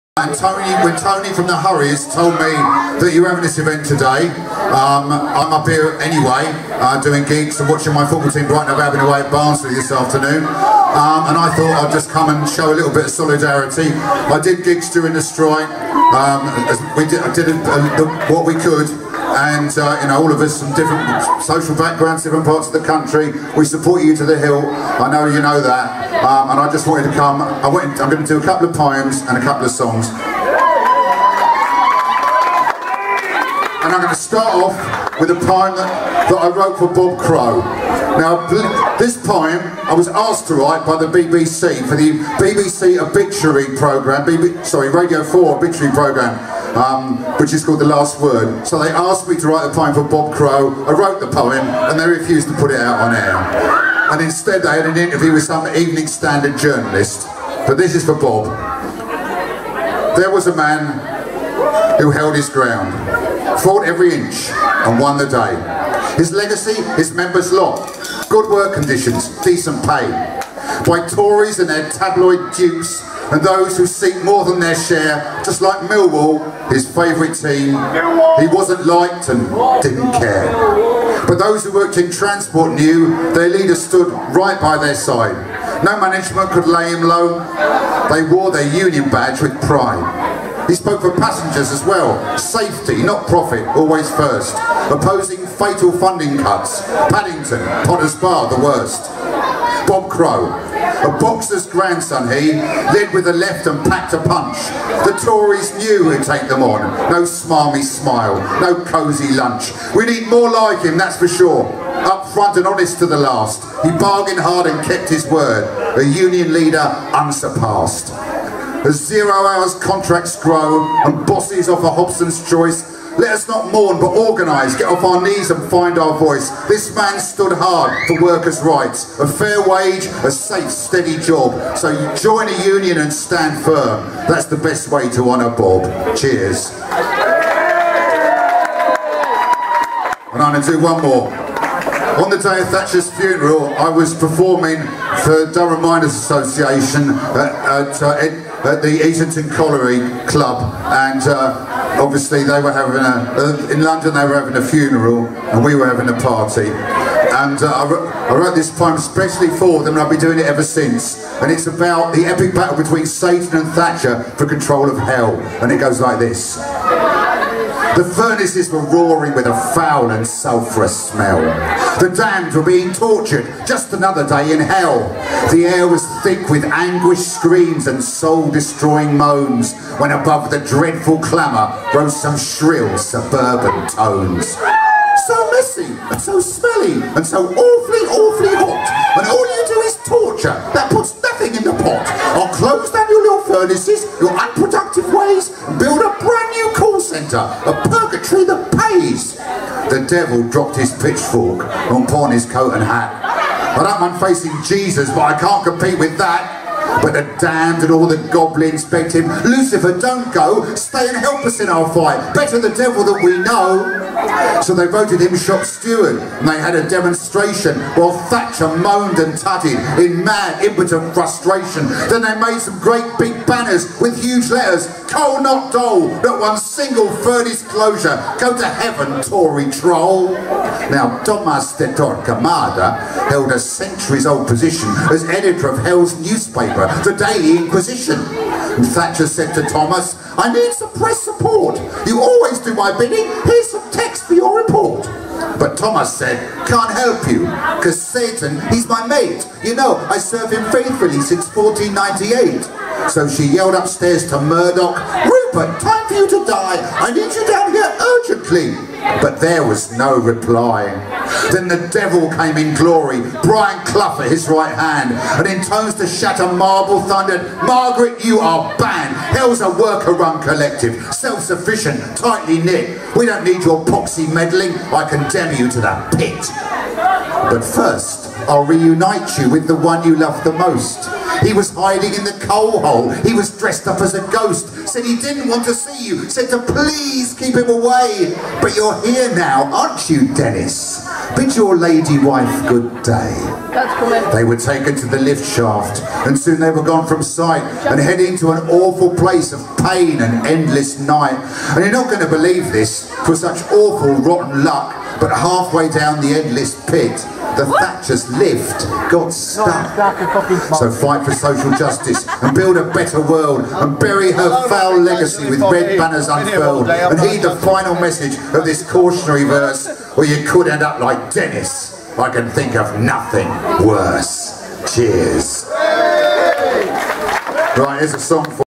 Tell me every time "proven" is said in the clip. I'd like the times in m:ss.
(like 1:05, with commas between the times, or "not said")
not said.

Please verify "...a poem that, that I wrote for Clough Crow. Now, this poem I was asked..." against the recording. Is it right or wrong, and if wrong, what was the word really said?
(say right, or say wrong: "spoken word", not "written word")
wrong: "Bob", not "Clough".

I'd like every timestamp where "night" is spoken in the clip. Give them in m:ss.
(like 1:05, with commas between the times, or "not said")
5:00.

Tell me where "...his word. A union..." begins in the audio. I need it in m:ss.
1:55.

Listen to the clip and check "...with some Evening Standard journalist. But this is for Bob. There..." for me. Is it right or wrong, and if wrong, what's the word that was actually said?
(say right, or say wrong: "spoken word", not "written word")
right.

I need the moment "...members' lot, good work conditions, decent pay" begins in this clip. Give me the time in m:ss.
1:07.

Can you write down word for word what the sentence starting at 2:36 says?
And uh, I, wrote, I, wrote, this poem especially for them and I've been doing it ever since.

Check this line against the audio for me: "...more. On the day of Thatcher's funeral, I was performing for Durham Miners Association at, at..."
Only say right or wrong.
right.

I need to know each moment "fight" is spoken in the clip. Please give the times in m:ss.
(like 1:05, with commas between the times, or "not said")
3:31, 5:10.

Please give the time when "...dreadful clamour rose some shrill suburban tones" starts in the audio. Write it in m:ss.
3:00.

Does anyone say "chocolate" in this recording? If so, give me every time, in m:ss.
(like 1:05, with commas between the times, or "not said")
not said.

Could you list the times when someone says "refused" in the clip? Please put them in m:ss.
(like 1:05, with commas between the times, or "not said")
0:52.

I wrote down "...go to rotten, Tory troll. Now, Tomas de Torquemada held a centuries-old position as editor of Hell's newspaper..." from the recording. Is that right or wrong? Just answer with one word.
wrong.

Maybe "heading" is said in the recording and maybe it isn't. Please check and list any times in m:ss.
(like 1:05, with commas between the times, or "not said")
4:57.